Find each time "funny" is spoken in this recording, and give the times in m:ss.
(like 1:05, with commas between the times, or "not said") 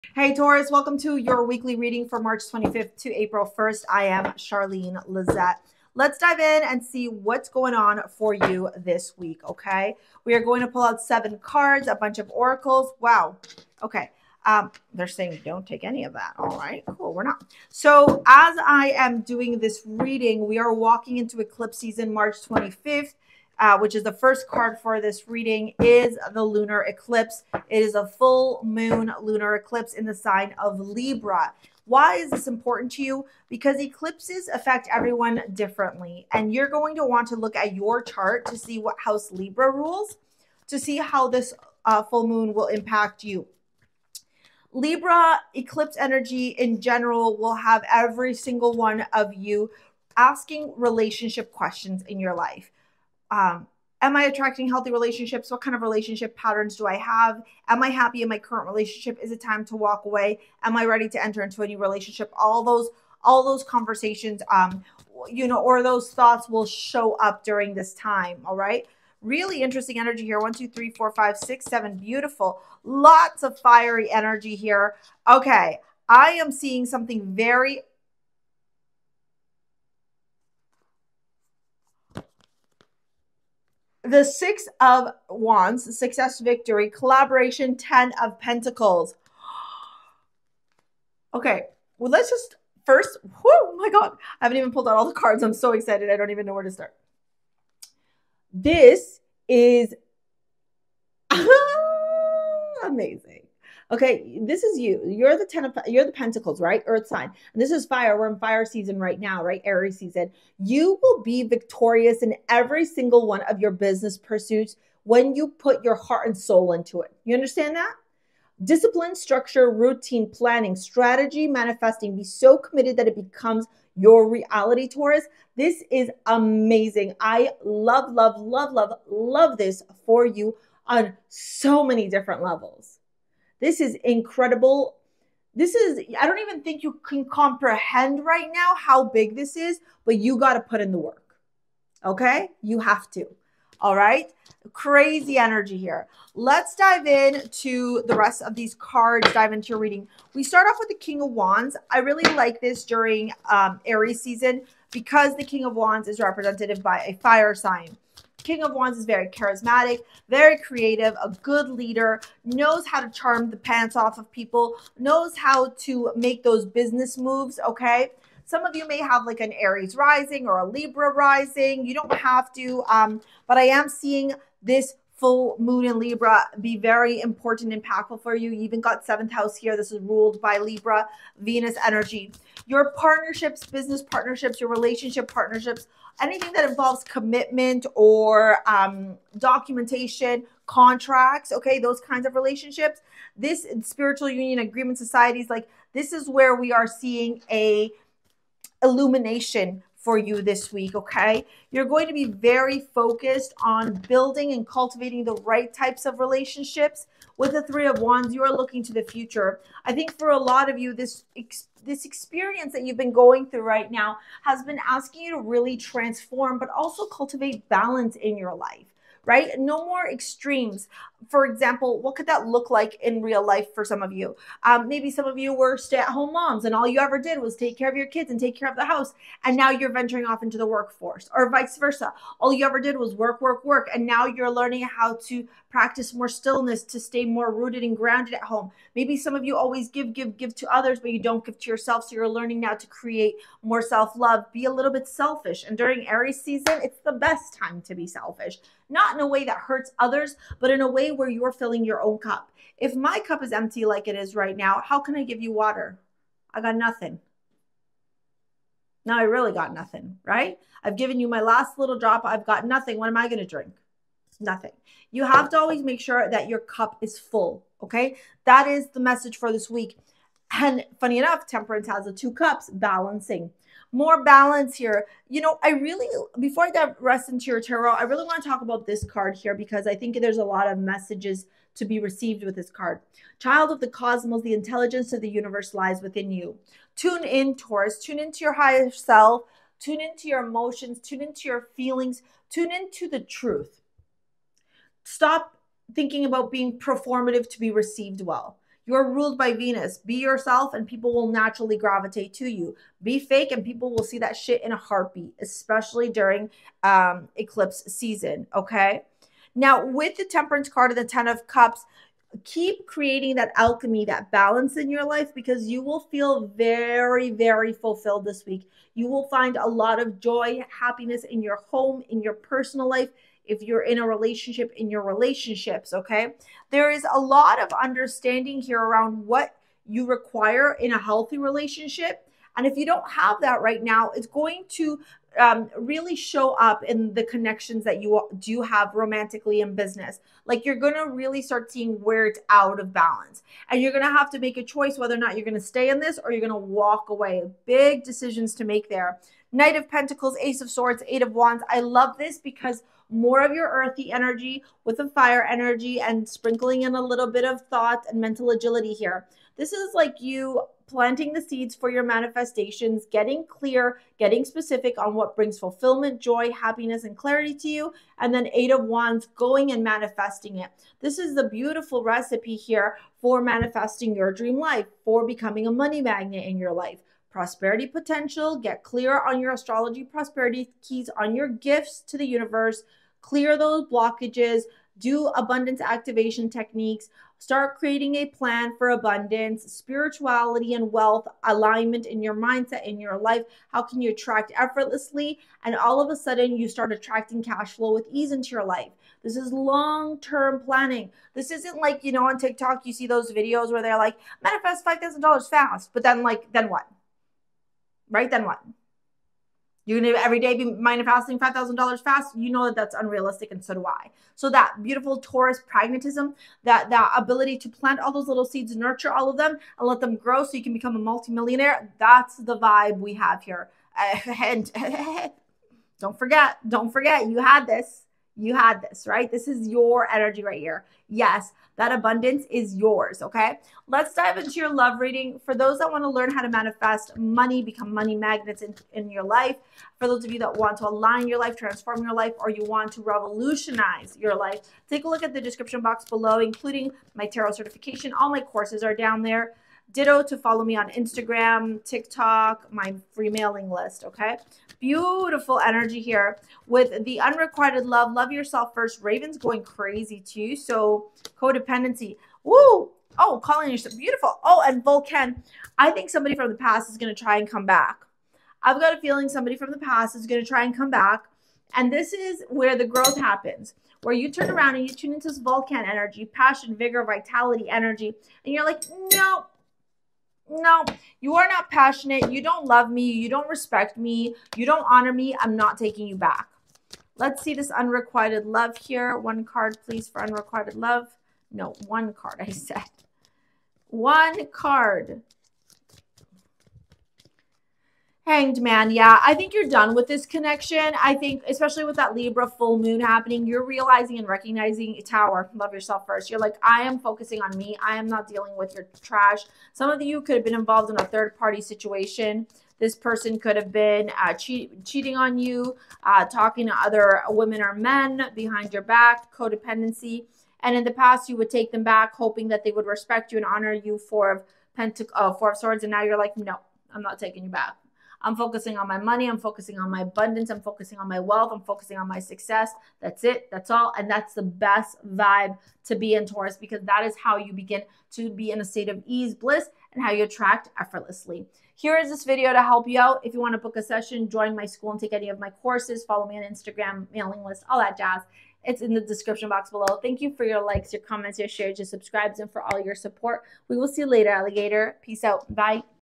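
4:30.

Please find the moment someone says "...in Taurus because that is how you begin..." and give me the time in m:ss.
8:56.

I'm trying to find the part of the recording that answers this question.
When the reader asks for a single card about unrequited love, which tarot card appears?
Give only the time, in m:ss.
8:18.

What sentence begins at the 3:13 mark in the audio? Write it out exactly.
This spiritual union agreement societies, like this is where we are seeing a illumination for you this week, okay?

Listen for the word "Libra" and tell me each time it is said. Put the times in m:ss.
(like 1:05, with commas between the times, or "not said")
0:30, 0:39, 0:44, 2:50, 2:55, 3:00, 8:22.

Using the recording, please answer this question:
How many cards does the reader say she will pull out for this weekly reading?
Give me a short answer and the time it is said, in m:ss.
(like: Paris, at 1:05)
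7, at 0:11.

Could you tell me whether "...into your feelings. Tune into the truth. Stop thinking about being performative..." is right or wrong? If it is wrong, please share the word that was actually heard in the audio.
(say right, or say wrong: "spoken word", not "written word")
right.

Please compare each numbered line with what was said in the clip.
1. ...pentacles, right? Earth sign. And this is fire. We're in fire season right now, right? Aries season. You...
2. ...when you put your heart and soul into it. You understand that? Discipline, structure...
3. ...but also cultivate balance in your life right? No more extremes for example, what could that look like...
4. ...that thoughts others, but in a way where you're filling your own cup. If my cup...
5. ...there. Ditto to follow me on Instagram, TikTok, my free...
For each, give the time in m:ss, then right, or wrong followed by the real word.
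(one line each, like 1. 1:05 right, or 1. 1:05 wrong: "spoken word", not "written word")
1. 1:46 right
2. 1:55 right
3. 3:36 right
4. 4:09 wrong: "hurts", not "thoughts"
5. 7:29 right.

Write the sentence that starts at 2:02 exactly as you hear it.
Be so committed that it becomes your reality, Taurus.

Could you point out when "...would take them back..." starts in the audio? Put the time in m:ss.
8:41.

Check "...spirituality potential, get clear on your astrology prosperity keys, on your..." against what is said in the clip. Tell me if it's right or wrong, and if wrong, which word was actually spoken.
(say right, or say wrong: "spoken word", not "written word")
wrong: "prosperity", not "spirituality".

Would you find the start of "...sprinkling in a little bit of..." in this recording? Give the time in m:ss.
5:56.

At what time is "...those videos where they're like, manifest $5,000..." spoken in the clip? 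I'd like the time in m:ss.
6:43.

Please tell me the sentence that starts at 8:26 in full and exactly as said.
You're like, I am focusing on me.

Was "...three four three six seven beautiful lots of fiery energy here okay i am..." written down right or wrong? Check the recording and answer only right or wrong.
wrong.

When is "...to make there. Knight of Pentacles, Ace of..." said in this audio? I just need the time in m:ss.
5:48.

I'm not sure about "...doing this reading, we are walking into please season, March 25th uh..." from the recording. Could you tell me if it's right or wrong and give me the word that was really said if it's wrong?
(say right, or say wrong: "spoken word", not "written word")
wrong: "eclipse", not "please".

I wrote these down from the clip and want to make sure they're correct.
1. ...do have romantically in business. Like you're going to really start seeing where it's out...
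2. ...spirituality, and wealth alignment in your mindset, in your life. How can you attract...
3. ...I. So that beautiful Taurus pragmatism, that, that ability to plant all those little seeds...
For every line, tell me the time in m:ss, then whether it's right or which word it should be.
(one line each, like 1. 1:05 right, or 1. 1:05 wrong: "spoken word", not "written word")
1. 5:38 right
2. 6:29 right
3. 6:53 right.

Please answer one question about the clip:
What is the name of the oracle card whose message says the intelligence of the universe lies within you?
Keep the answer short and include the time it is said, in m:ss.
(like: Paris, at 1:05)
Child of the cosmos, at 4:43.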